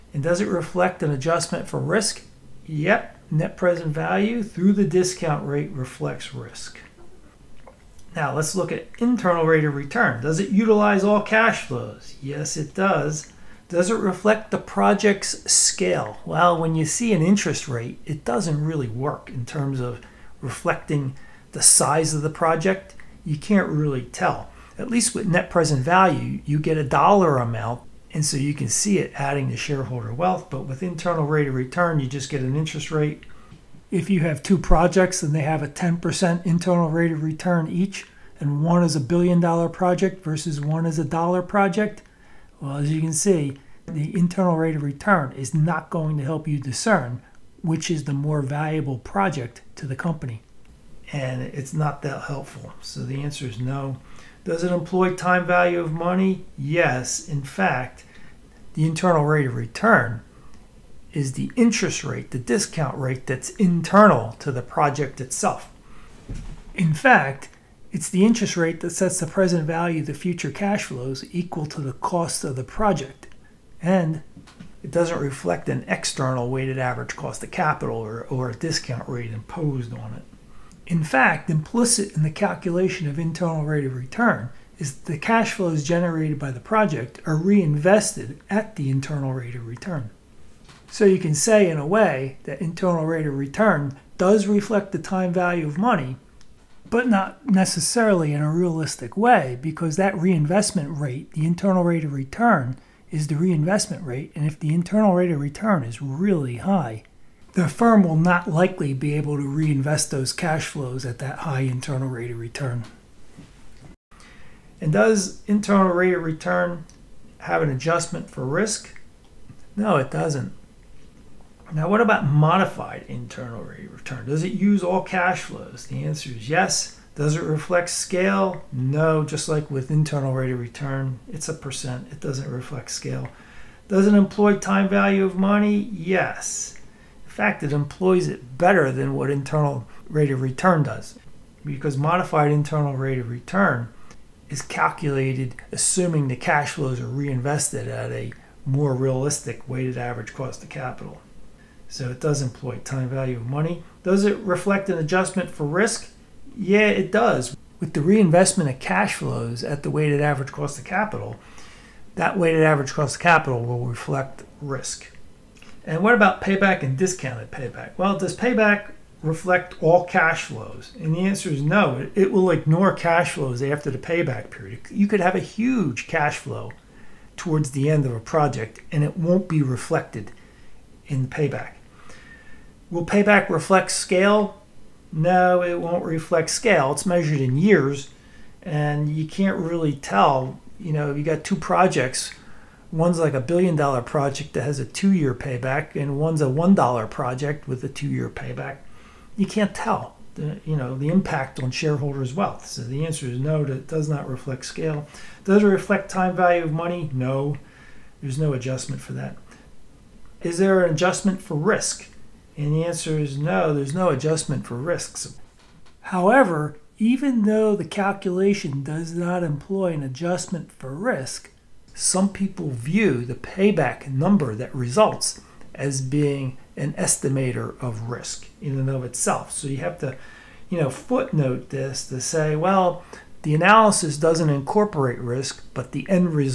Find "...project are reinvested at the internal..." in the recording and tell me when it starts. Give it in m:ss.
1:26.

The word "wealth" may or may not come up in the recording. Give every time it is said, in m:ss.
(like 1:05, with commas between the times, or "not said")
0:30, 3:22.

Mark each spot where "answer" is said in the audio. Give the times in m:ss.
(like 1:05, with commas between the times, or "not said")
0:53, 2:06, 2:51, 3:23, 3:32.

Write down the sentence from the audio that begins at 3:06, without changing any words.
It's measured in years, and you can't really tell.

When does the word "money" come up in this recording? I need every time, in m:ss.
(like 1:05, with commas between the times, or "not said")
0:55, 1:35, 2:15, 2:33, 3:26.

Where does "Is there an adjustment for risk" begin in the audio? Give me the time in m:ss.
3:30.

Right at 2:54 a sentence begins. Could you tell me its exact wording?
You could have a huge cash flow towards the end of a project and it won't be reflected in payback.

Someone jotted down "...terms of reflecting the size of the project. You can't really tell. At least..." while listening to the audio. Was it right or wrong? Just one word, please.
right.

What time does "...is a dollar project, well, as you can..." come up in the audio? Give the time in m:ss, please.
0:40.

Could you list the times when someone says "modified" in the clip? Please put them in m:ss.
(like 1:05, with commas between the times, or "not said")
2:02, 2:21.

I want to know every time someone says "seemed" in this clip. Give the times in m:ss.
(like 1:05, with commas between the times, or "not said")
not said.